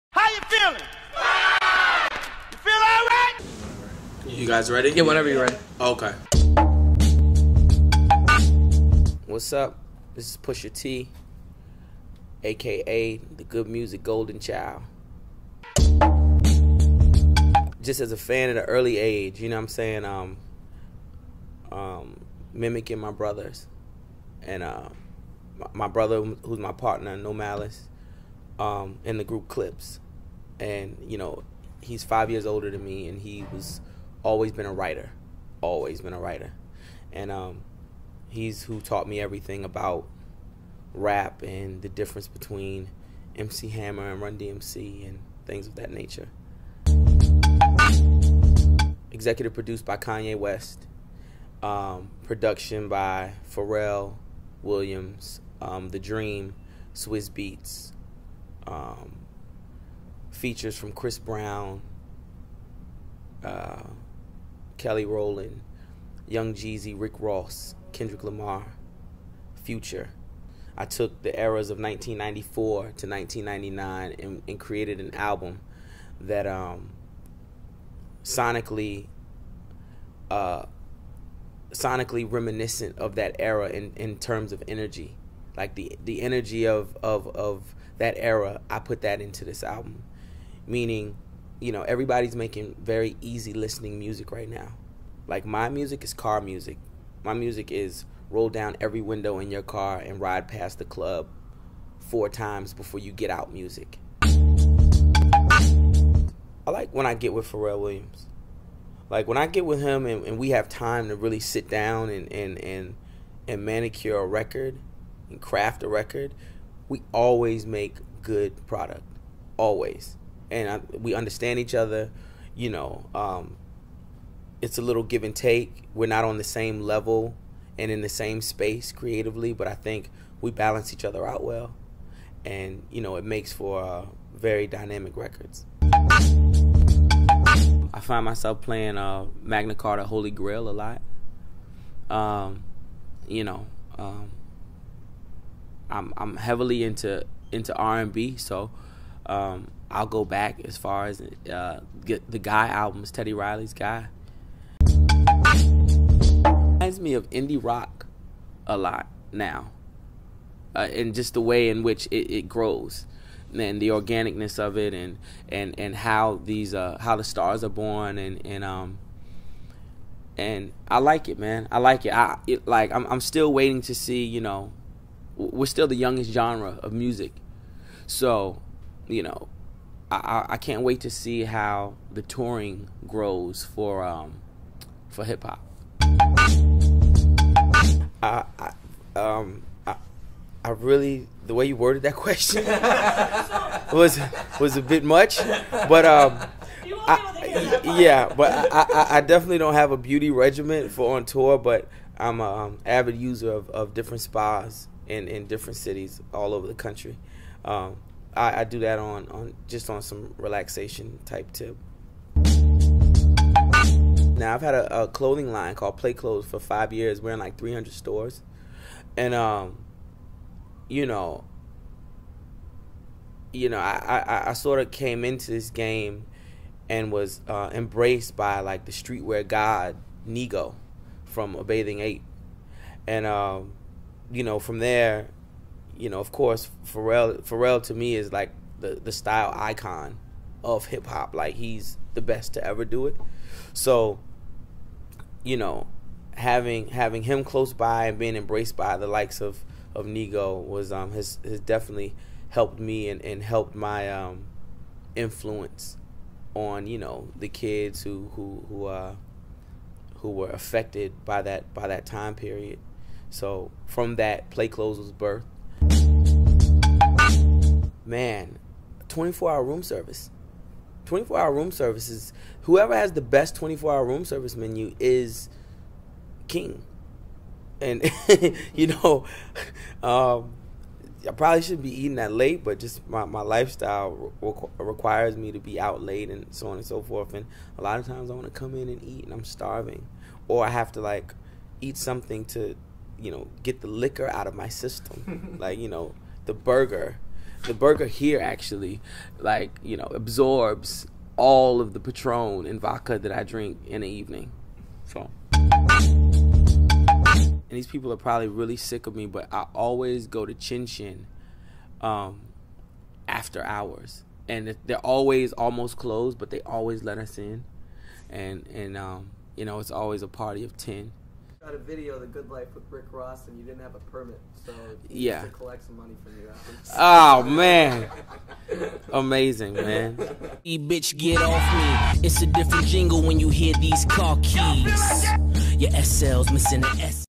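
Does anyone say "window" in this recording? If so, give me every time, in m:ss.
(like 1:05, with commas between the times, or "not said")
1:39.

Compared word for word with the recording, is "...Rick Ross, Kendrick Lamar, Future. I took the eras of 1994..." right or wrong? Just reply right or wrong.
right.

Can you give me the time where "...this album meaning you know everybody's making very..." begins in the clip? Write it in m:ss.
1:29.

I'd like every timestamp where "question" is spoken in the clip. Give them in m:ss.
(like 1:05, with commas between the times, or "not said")
3:12.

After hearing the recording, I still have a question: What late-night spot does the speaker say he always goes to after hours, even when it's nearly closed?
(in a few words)
Chin Chin.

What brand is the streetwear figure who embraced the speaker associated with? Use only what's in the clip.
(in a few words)
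A Bathing Ape.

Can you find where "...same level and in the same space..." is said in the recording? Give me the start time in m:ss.
2:06.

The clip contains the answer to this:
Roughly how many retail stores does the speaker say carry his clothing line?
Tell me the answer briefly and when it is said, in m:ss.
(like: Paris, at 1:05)
300, at 3:37.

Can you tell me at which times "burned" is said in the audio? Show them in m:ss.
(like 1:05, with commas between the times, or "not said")
not said.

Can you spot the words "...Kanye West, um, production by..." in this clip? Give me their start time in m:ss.
0:49.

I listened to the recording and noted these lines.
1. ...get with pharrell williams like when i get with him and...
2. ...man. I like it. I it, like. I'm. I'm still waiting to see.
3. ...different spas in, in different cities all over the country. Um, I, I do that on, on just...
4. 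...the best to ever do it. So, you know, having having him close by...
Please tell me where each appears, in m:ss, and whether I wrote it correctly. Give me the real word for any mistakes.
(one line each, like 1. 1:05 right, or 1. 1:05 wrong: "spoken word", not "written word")
1. 1:47 right
2. 2:51 right
3. 3:23 right
4. 4:02 right.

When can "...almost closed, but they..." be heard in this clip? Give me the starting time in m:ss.
5:15.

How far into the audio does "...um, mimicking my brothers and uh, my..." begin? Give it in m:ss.
0:21.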